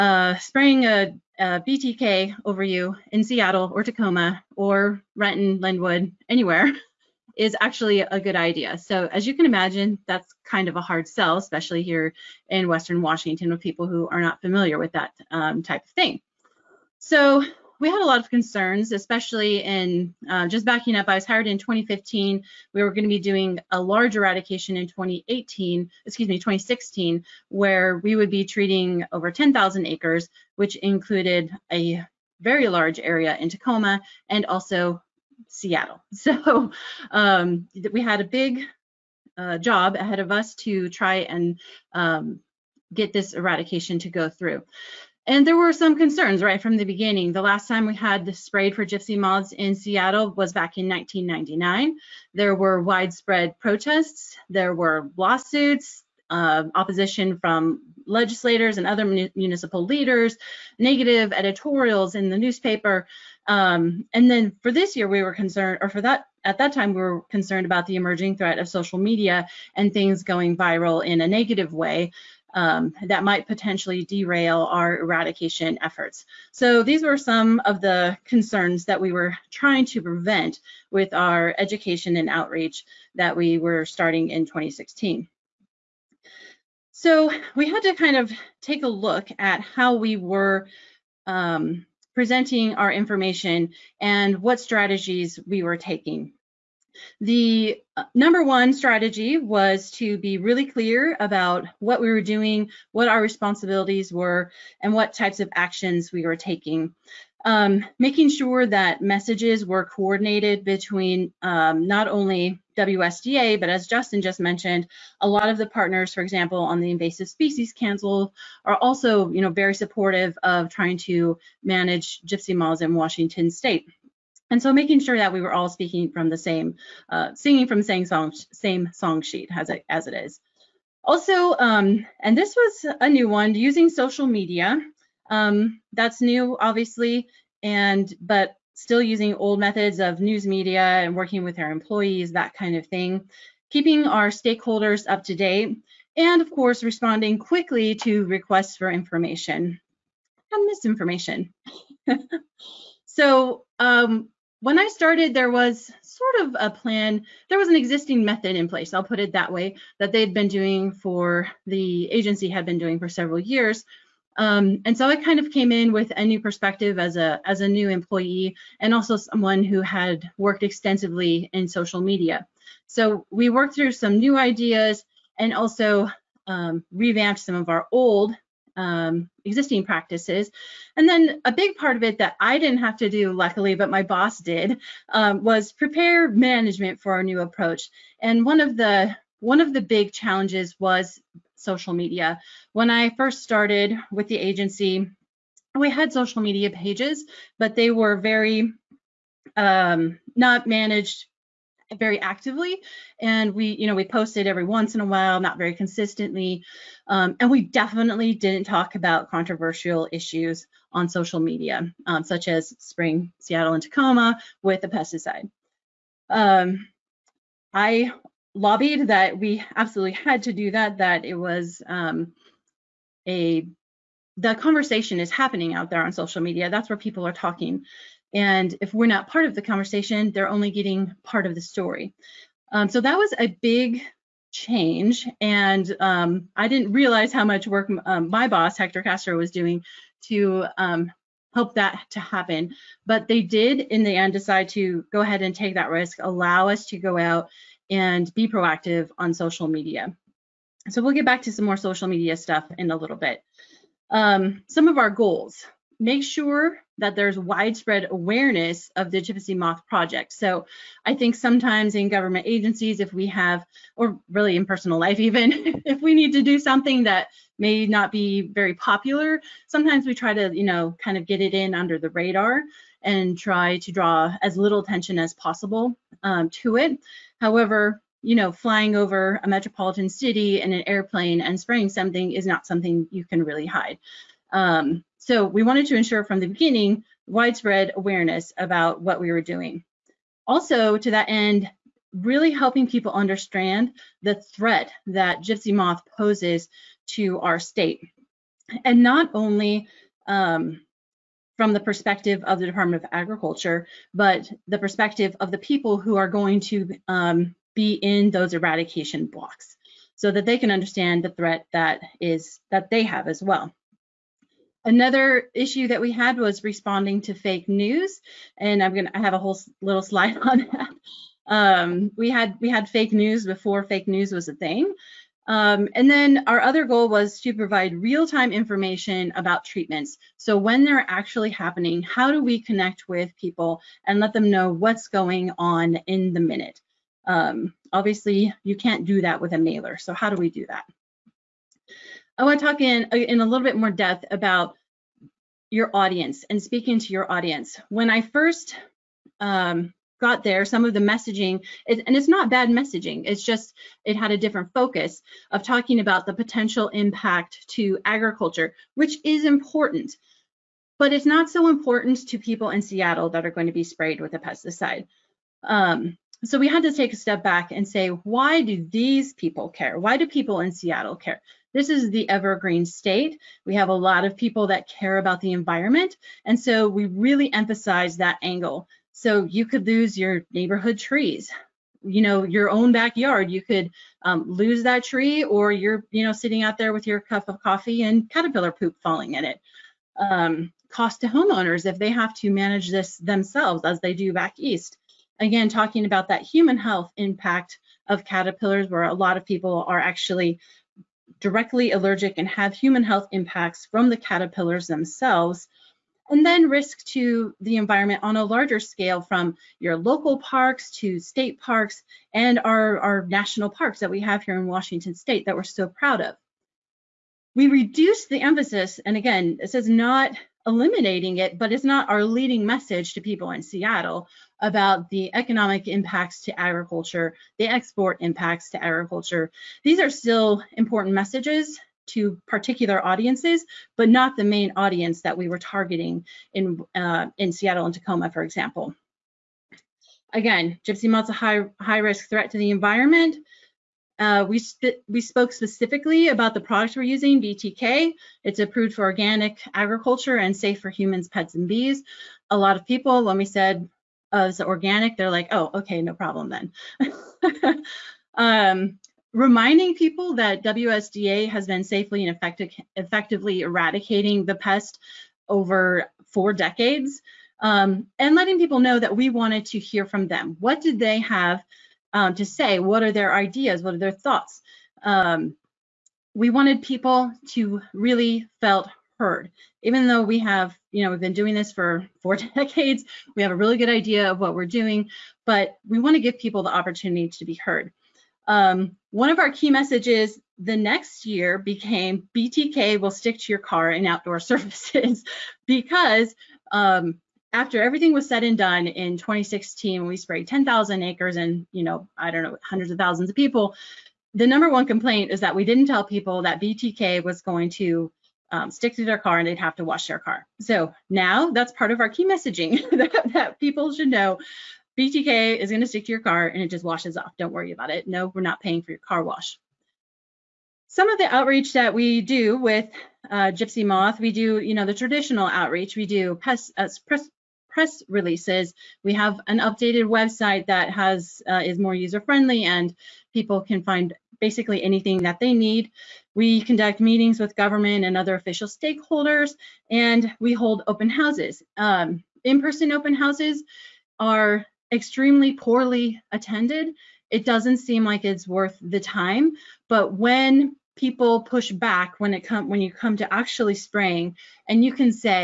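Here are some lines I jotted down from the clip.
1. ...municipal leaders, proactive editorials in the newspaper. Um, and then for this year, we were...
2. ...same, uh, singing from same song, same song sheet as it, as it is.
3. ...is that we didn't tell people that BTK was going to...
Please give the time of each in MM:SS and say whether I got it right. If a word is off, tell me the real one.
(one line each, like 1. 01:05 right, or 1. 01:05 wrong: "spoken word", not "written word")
1. 00:59 wrong: "negative", not "proactive"
2. 02:06 right
3. 08:25 right.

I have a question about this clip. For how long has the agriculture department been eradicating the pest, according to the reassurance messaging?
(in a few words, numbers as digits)
four decades.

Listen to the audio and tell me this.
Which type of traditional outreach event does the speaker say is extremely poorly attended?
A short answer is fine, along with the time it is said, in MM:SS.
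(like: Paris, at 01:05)
in-person open houses, at 09:02.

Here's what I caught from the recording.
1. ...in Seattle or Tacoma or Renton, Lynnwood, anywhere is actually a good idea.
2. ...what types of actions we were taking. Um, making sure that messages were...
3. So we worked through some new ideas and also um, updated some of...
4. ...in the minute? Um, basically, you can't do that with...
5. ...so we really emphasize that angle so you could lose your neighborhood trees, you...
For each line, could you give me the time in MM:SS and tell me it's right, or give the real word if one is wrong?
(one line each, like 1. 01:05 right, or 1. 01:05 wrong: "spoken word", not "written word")
1. 00:03 right
2. 01:44 right
3. 02:52 wrong: "revamped", not "updated"
4. 05:36 wrong: "obviously", not "basically"
5. 06:16 right.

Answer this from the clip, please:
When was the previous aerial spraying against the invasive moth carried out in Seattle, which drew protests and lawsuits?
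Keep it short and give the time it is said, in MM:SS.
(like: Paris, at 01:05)
1999, at 00:50.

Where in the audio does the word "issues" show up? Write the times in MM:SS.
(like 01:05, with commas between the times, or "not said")
03:30, 05:15.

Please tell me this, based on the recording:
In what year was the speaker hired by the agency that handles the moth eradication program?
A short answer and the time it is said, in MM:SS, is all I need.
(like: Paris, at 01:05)
2015, at 00:21.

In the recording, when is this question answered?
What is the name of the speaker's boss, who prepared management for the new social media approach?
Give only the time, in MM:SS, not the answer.
03:58.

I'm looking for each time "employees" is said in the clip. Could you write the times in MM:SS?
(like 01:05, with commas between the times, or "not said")
02:21, 02:47.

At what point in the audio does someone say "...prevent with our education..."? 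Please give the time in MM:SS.
01:20.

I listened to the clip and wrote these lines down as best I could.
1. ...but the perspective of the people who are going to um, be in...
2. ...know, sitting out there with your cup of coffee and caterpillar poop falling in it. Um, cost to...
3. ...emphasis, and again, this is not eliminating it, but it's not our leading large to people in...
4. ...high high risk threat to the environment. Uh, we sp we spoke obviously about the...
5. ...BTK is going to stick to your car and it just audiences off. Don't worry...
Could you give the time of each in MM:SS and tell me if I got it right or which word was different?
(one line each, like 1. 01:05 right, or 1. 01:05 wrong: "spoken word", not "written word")
1. 05:04 right
2. 06:26 right
3. 06:58 wrong: "message", not "large"
4. 07:21 wrong: "specifically", not "obviously"
5. 08:34 wrong: "washes", not "audiences".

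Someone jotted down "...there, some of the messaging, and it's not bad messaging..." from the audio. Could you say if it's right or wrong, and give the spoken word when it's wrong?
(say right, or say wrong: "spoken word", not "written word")
right.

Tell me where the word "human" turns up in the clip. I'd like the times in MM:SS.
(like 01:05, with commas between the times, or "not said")
06:36, 06:42, 07:30.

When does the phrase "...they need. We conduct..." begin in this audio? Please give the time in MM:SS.
08:55.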